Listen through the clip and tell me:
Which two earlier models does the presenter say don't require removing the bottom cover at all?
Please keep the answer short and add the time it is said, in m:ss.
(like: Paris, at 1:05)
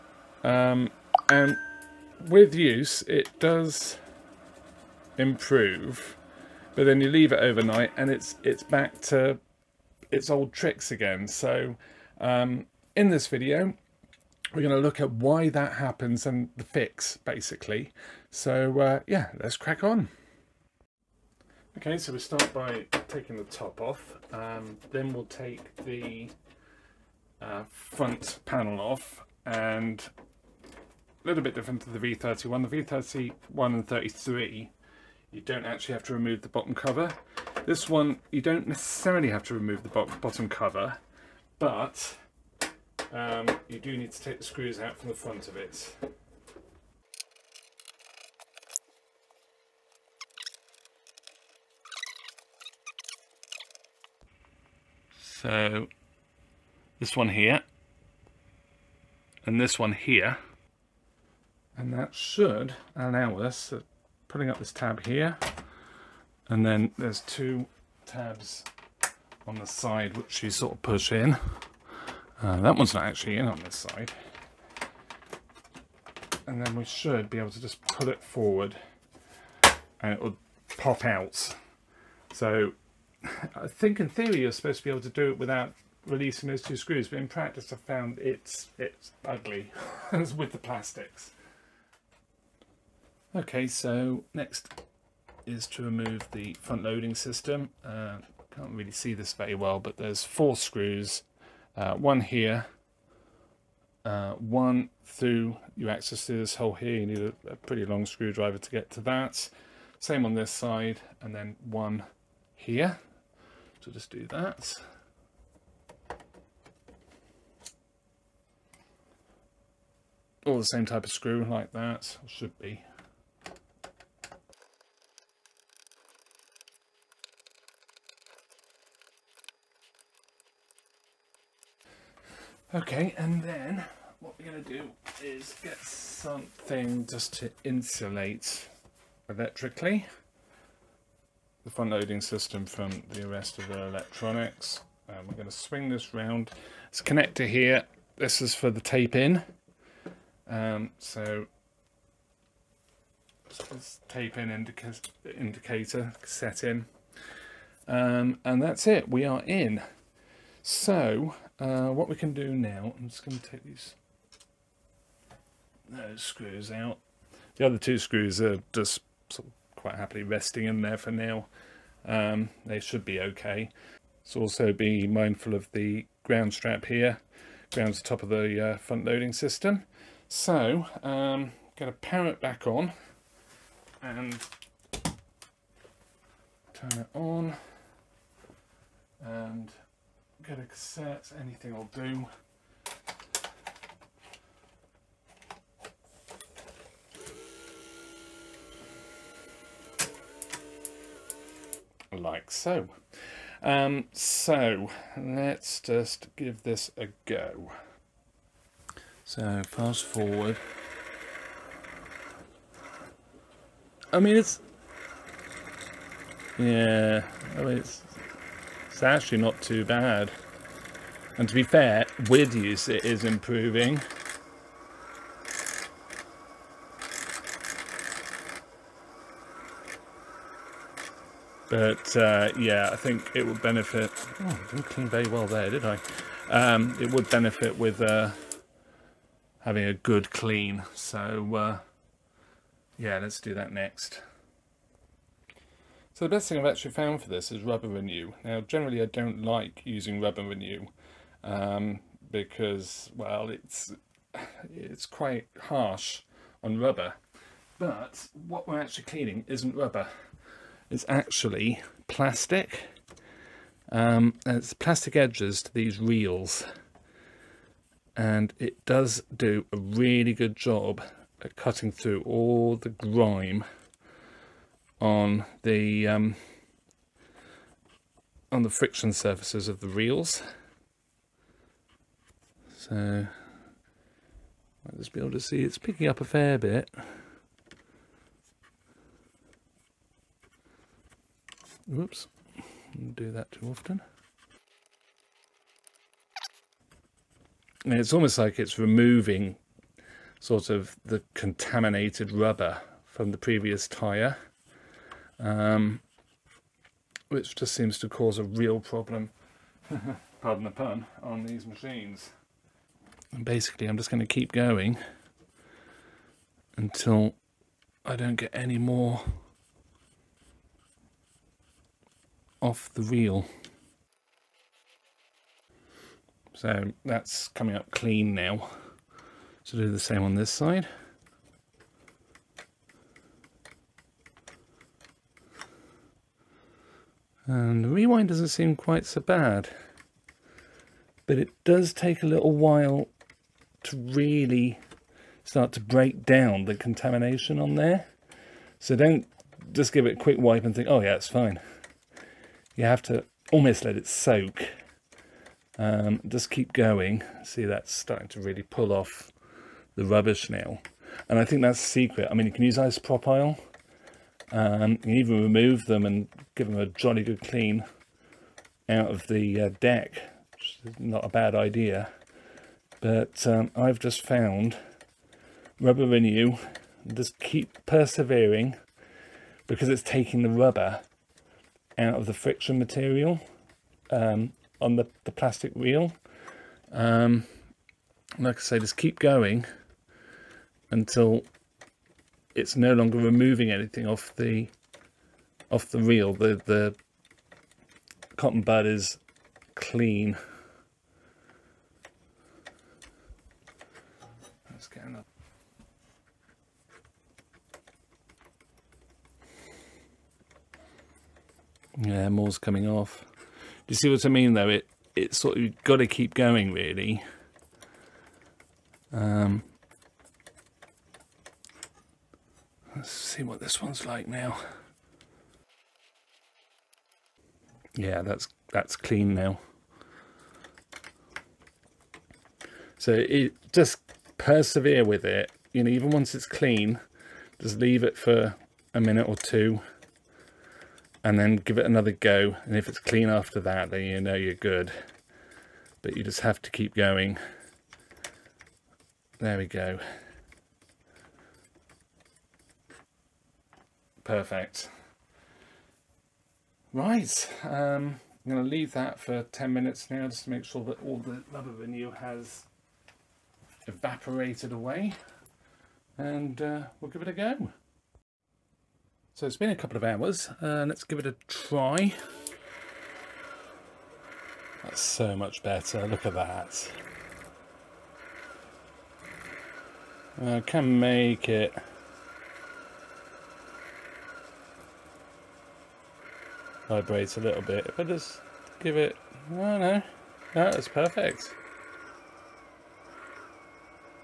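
V31 and 33, at 0:32.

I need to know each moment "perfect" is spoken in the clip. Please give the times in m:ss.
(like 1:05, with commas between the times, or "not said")
7:34, 8:10.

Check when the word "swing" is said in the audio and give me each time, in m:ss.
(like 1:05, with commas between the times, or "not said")
2:25.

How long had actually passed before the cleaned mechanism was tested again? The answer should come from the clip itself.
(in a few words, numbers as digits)
A couple of hours.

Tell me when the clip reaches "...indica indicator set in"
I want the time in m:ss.
2:34.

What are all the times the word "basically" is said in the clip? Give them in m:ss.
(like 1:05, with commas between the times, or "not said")
0:17, 5:13.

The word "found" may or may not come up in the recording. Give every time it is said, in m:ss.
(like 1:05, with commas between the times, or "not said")
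1:27, 4:06, 6:14.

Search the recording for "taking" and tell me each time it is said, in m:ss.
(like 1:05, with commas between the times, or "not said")
0:23, 6:20.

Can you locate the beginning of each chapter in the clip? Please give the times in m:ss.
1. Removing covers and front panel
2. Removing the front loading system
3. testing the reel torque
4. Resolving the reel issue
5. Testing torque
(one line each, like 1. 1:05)
1. 0:20
2. 1:32
3. 3:29
4. 4:03
5. 7:48.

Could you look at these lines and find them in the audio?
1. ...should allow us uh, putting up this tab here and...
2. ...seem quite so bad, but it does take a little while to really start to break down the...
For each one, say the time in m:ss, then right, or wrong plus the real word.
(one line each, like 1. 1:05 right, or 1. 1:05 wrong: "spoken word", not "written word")
1. 1:02 right
2. 5:38 right.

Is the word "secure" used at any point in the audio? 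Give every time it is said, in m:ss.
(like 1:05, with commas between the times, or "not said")
not said.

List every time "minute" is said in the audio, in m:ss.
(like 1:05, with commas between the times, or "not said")
7:19, 7:39.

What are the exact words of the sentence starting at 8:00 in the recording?
I uh, can make it vibrates a little bit.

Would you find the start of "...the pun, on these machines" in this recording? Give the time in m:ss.
5:10.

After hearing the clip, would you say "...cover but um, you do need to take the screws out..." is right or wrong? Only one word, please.
right.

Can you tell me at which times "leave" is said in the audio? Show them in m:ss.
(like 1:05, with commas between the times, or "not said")
0:07, 7:17, 7:38.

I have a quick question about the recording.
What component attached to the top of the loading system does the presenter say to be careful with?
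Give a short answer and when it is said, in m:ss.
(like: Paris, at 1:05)
Ground strap, at 2:56.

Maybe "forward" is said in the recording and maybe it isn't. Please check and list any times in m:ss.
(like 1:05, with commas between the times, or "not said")
1:18, 3:30.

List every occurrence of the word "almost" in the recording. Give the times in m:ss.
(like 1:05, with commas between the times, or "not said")
4:58, 5:53.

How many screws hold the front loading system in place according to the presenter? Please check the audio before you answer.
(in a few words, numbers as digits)
4.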